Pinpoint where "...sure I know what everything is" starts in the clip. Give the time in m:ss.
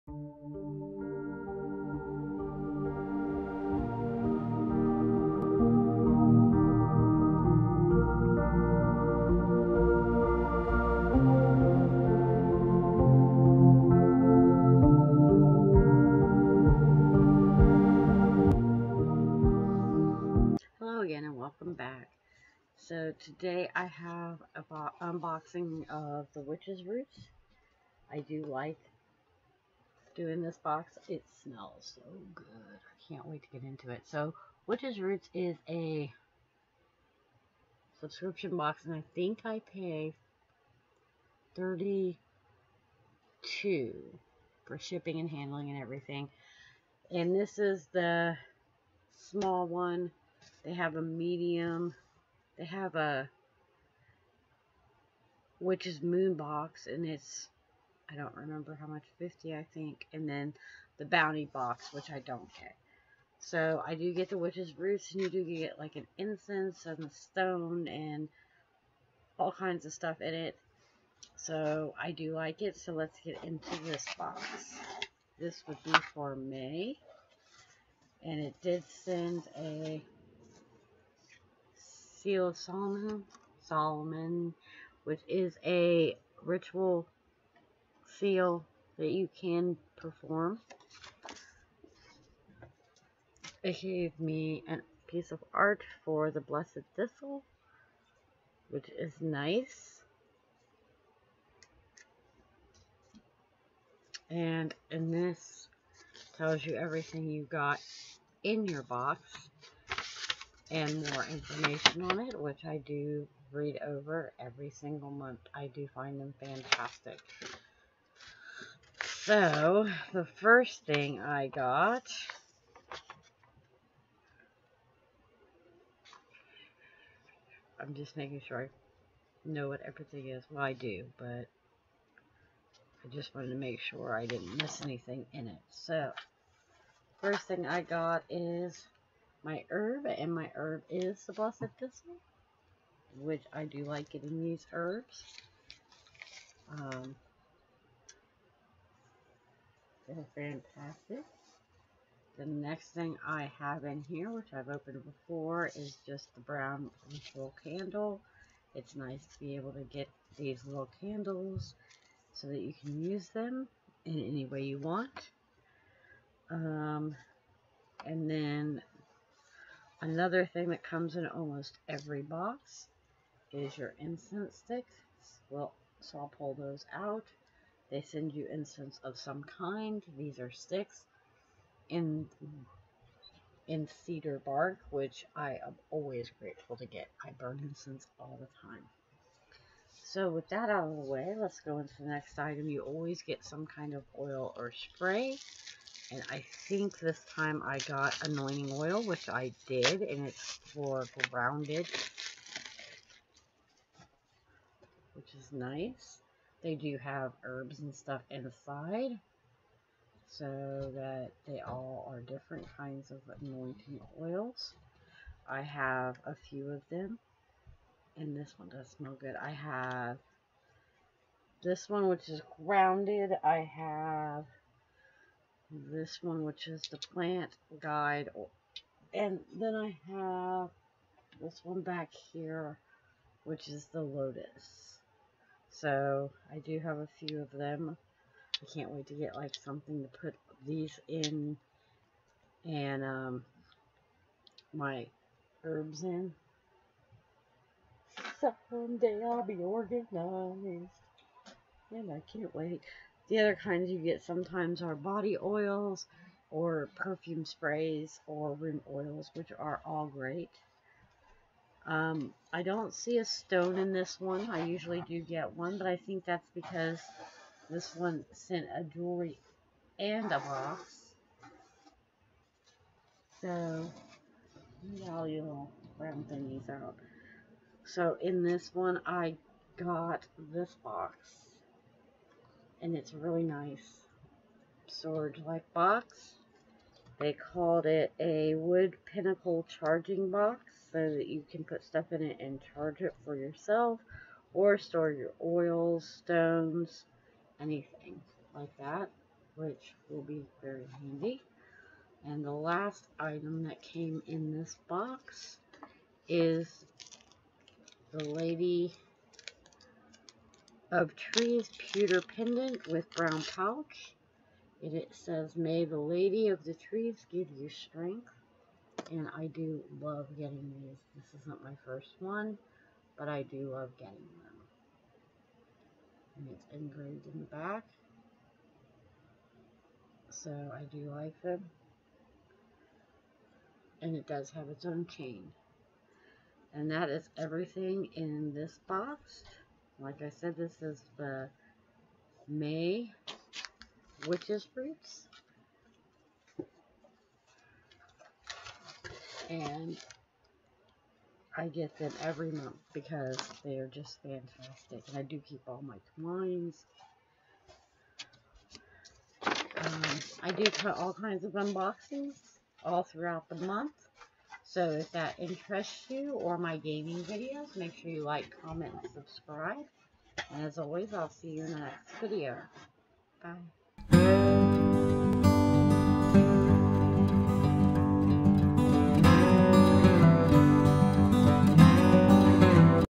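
2:08.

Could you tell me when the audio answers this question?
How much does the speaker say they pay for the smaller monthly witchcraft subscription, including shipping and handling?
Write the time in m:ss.
0:41.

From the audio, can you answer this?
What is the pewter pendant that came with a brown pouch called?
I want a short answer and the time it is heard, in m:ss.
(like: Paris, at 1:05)
Lady of Trees, at 5:08.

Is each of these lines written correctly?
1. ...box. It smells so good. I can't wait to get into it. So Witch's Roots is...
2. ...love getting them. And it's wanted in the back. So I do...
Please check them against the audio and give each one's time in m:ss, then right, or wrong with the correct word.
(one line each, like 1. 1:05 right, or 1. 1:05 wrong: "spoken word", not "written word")
1. 0:30 right
2. 5:23 wrong: "engraved", not "wanted".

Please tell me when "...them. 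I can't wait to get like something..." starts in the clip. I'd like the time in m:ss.
3:57.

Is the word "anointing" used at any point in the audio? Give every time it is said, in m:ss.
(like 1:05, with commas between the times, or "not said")
3:18, 3:33.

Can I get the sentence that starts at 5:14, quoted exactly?
And it says, may the lady of the trees give you strength.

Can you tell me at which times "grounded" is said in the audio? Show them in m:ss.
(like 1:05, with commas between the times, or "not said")
3:21, 3:42.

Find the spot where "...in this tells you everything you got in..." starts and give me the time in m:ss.
1:44.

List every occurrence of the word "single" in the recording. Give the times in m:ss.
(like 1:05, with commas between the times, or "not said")
1:54.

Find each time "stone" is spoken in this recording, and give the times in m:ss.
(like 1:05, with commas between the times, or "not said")
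1:07, 4:23, 4:56.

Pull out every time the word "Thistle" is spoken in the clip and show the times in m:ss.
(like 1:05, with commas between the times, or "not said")
1:36, 2:21.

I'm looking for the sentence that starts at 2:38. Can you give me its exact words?
It's nice to be able to get these little candles so that you can use them in any way you want.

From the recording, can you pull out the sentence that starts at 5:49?
And I get them every month because they are just fantastic.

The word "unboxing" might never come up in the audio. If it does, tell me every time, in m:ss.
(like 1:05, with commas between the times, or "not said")
0:25, 6:01.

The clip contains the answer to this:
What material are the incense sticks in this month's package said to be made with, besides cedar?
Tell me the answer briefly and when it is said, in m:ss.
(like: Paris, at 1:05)
bark, at 3:04.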